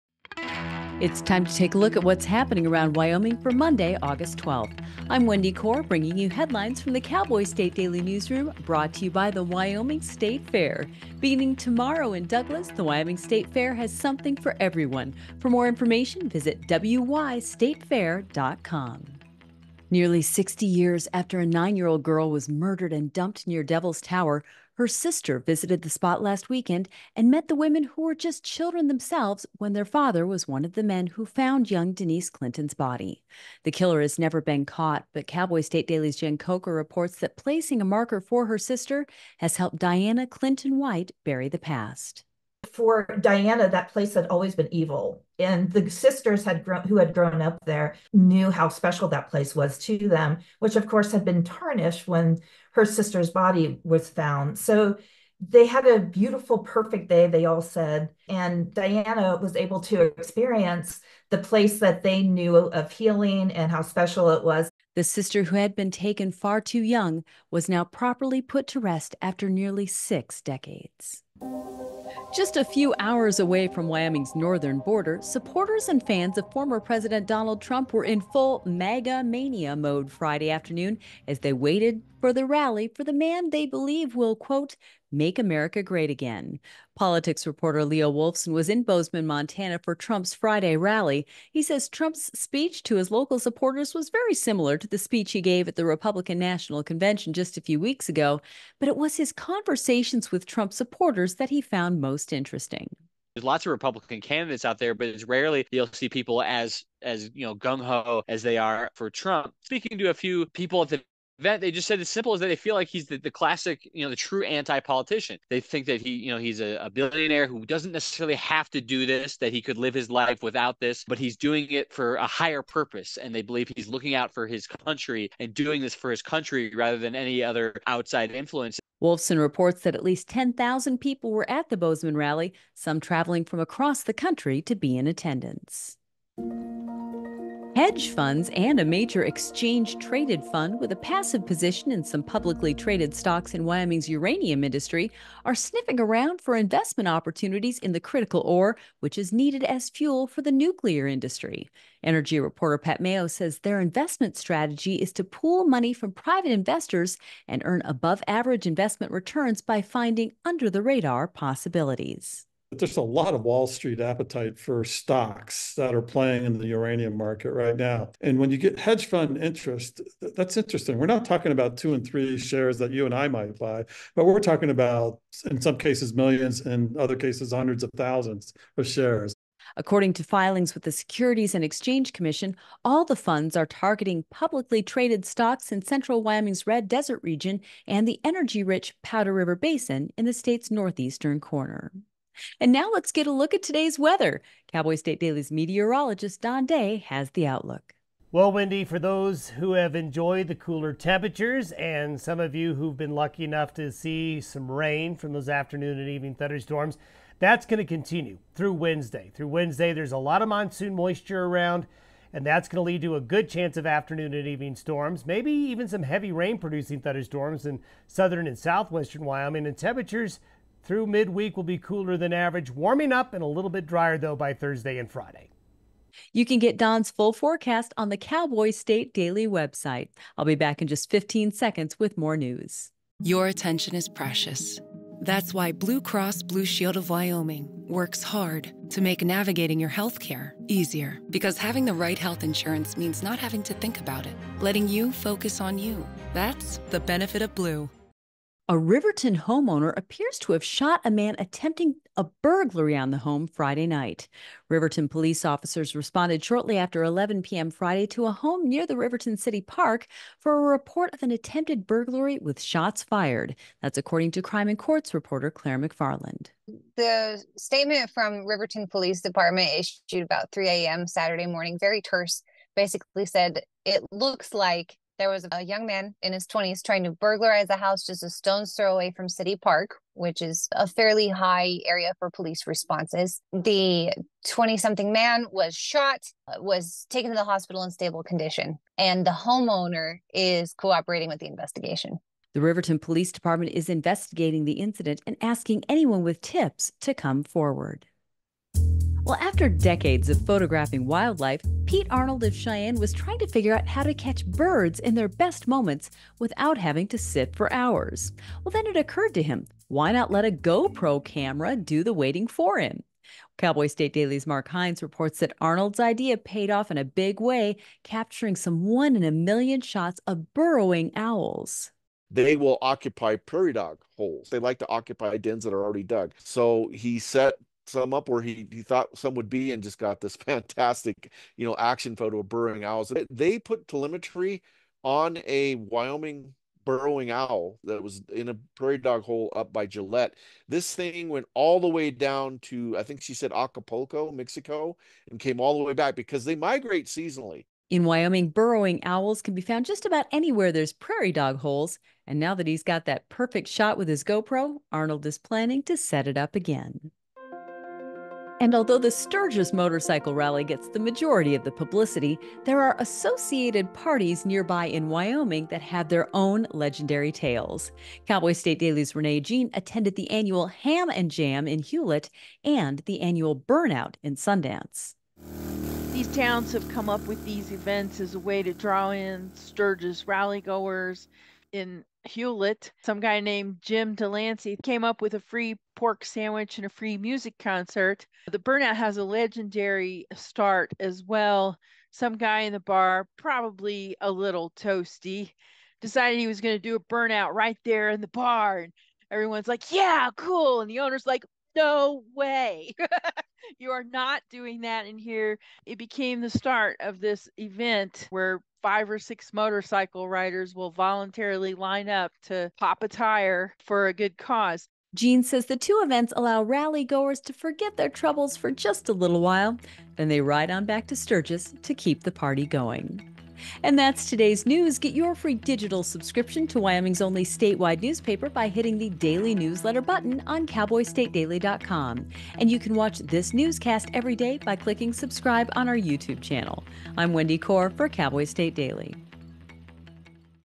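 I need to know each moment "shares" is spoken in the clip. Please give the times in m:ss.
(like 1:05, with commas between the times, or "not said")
2:52, 2:58.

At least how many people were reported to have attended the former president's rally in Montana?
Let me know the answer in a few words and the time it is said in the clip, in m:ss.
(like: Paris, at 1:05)
10,000, at 2:10.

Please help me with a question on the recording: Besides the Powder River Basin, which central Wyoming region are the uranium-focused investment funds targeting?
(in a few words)
Red Desert.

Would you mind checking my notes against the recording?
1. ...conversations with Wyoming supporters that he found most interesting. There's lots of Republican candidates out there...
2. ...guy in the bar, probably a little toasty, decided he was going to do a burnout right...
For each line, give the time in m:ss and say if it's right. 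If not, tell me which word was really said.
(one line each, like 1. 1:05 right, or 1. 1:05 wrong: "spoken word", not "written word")
1. 1:39 wrong: "Trump", not "Wyoming"
2. 6:32 right.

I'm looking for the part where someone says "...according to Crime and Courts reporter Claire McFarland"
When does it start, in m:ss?
4:23.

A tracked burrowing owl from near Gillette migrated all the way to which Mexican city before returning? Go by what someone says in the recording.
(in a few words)
Acapulco.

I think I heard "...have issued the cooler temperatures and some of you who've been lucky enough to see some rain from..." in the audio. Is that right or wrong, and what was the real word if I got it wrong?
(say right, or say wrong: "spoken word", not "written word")
wrong: "enjoyed", not "issued".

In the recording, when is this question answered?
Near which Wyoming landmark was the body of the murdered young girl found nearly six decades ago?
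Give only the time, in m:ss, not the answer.
0:23.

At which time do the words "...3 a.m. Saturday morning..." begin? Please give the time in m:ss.
4:30.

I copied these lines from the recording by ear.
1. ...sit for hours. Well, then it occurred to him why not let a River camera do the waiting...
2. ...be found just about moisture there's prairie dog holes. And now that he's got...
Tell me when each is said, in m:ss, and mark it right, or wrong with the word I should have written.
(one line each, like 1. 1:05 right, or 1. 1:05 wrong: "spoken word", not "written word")
1. 5:07 wrong: "GoPro", not "River"
2. 5:49 wrong: "anywhere", not "moisture".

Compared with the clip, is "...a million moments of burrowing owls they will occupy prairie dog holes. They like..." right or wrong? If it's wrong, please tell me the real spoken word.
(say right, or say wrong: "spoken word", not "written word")
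wrong: "shots", not "moments".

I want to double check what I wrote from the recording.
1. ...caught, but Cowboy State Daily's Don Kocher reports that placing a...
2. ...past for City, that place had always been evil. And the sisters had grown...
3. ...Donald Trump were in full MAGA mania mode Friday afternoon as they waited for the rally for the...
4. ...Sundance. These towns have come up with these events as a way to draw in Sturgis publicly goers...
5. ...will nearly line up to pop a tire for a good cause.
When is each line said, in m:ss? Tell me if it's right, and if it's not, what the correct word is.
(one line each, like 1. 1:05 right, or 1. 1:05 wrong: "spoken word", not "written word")
1. 0:34 wrong: "Jen", not "Don"
2. 0:41 wrong: "Diana", not "City"
3. 1:17 right
4. 6:14 wrong: "rally", not "publicly"
5. 6:50 wrong: "voluntarily", not "nearly".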